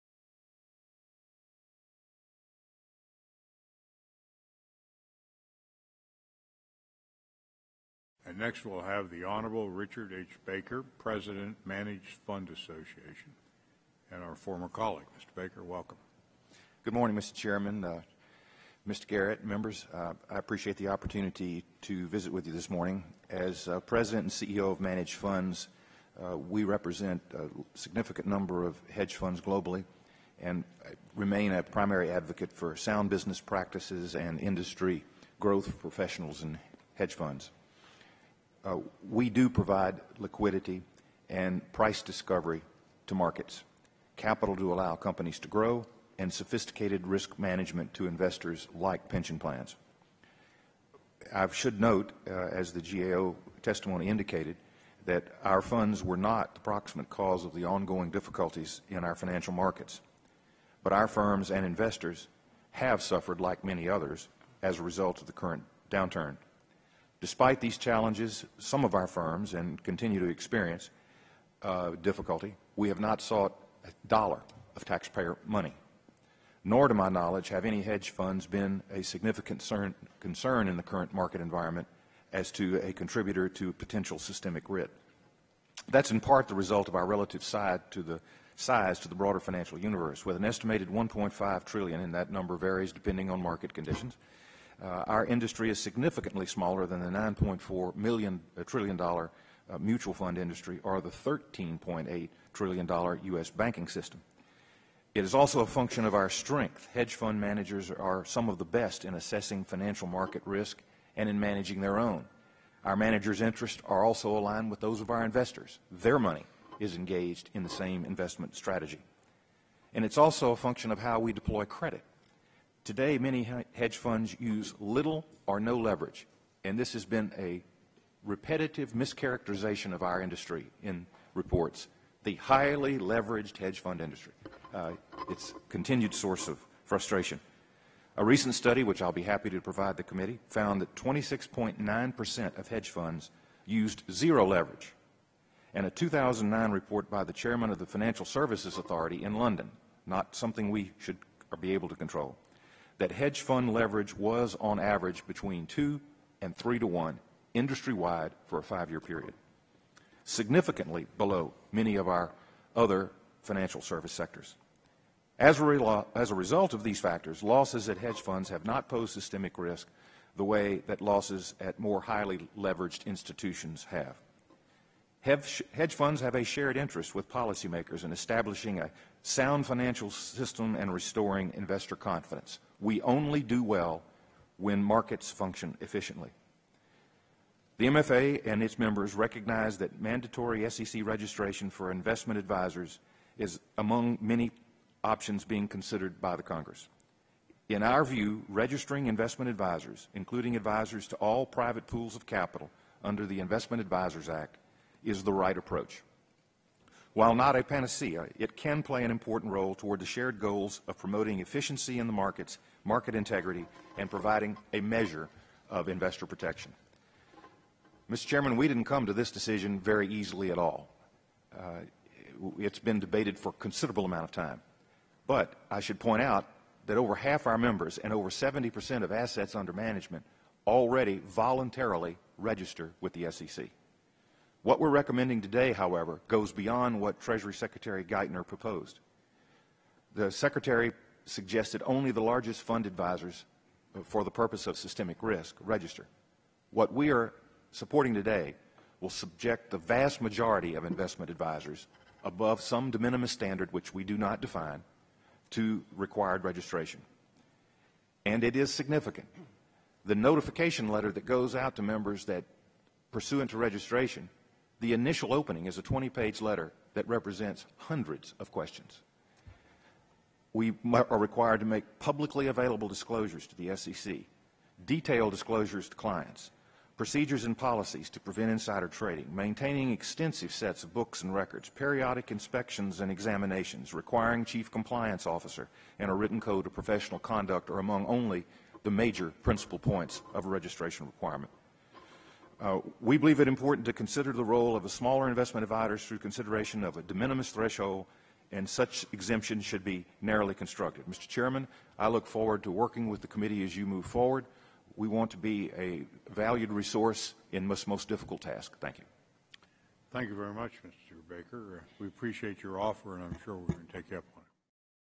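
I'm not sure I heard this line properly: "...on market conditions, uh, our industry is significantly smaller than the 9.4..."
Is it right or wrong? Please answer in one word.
right.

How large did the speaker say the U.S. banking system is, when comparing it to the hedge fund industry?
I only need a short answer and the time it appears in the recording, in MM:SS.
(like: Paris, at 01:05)
13.8 trillion dollars, at 01:41.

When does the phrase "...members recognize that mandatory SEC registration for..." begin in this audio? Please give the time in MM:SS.
03:08.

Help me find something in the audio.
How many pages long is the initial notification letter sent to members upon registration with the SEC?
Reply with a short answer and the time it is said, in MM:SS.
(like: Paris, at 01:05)
20, at 04:25.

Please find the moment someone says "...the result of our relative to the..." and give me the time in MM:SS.
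01:26.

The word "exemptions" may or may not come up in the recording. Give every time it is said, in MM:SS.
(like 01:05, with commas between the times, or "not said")
04:59.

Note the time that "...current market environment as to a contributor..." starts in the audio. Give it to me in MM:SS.
01:20.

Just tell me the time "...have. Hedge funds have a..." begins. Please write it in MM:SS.
02:53.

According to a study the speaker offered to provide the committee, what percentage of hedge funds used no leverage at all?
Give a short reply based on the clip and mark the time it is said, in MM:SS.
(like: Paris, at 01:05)
26.9%, at 02:20.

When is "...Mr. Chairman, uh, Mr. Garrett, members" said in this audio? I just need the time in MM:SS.
00:17.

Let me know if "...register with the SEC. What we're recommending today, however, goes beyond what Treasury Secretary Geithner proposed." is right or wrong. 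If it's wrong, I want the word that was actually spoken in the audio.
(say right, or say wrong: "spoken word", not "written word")
right.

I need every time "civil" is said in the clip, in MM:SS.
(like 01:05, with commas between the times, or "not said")
not said.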